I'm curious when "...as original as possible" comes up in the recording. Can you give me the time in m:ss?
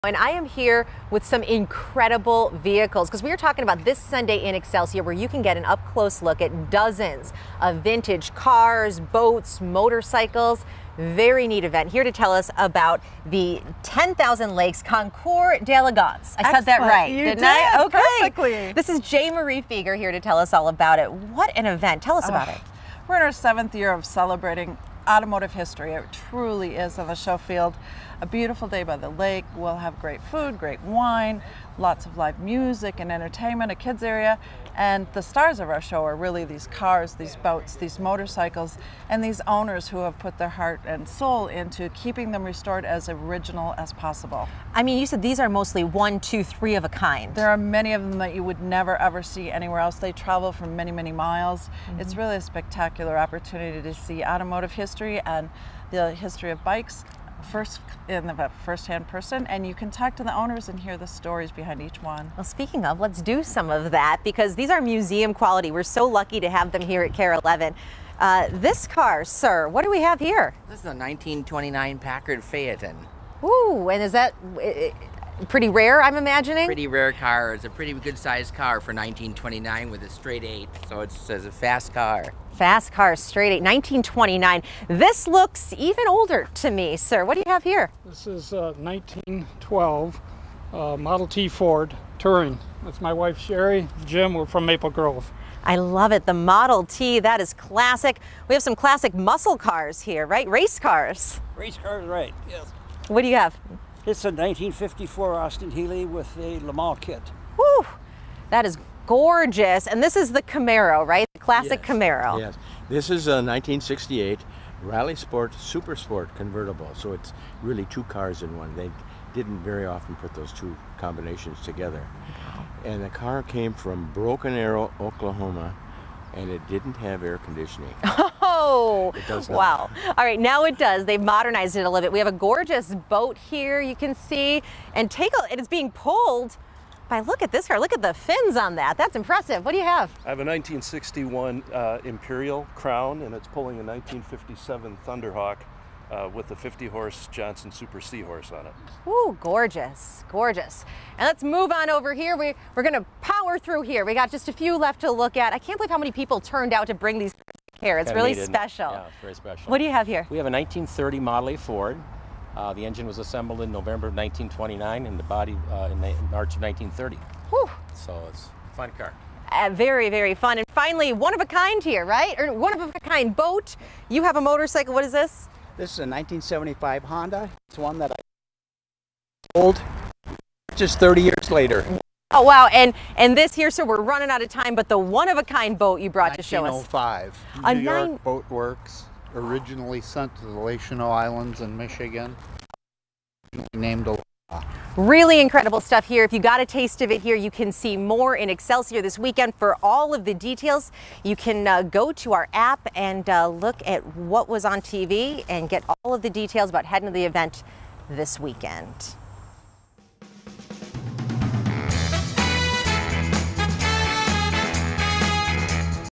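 0:42.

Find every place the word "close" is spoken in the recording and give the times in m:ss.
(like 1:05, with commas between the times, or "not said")
0:05.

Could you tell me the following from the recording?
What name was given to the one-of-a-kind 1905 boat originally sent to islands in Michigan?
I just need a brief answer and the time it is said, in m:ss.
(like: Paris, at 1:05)
Aloha, at 3:14.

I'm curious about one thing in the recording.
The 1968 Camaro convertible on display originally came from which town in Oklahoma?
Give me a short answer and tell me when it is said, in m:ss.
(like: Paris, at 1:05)
Broken Arrow, at 2:04.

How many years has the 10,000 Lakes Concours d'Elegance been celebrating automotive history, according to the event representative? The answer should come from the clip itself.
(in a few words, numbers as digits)
7.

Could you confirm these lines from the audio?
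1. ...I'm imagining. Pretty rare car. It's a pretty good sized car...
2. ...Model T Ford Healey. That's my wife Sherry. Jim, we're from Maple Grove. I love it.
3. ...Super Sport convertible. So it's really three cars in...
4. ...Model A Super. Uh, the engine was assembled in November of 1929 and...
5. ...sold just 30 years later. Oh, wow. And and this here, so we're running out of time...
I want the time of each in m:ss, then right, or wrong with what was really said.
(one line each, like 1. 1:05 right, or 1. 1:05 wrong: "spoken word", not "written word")
1. 1:16 right
2. 1:30 wrong: "Touring", not "Healey"
3. 1:55 wrong: "two", not "three"
4. 2:41 wrong: "Ford", not "Super"
5. 2:59 right.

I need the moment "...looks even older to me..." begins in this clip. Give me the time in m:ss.
1:25.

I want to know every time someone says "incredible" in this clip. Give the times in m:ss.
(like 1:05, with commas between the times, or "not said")
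0:01, 3:15.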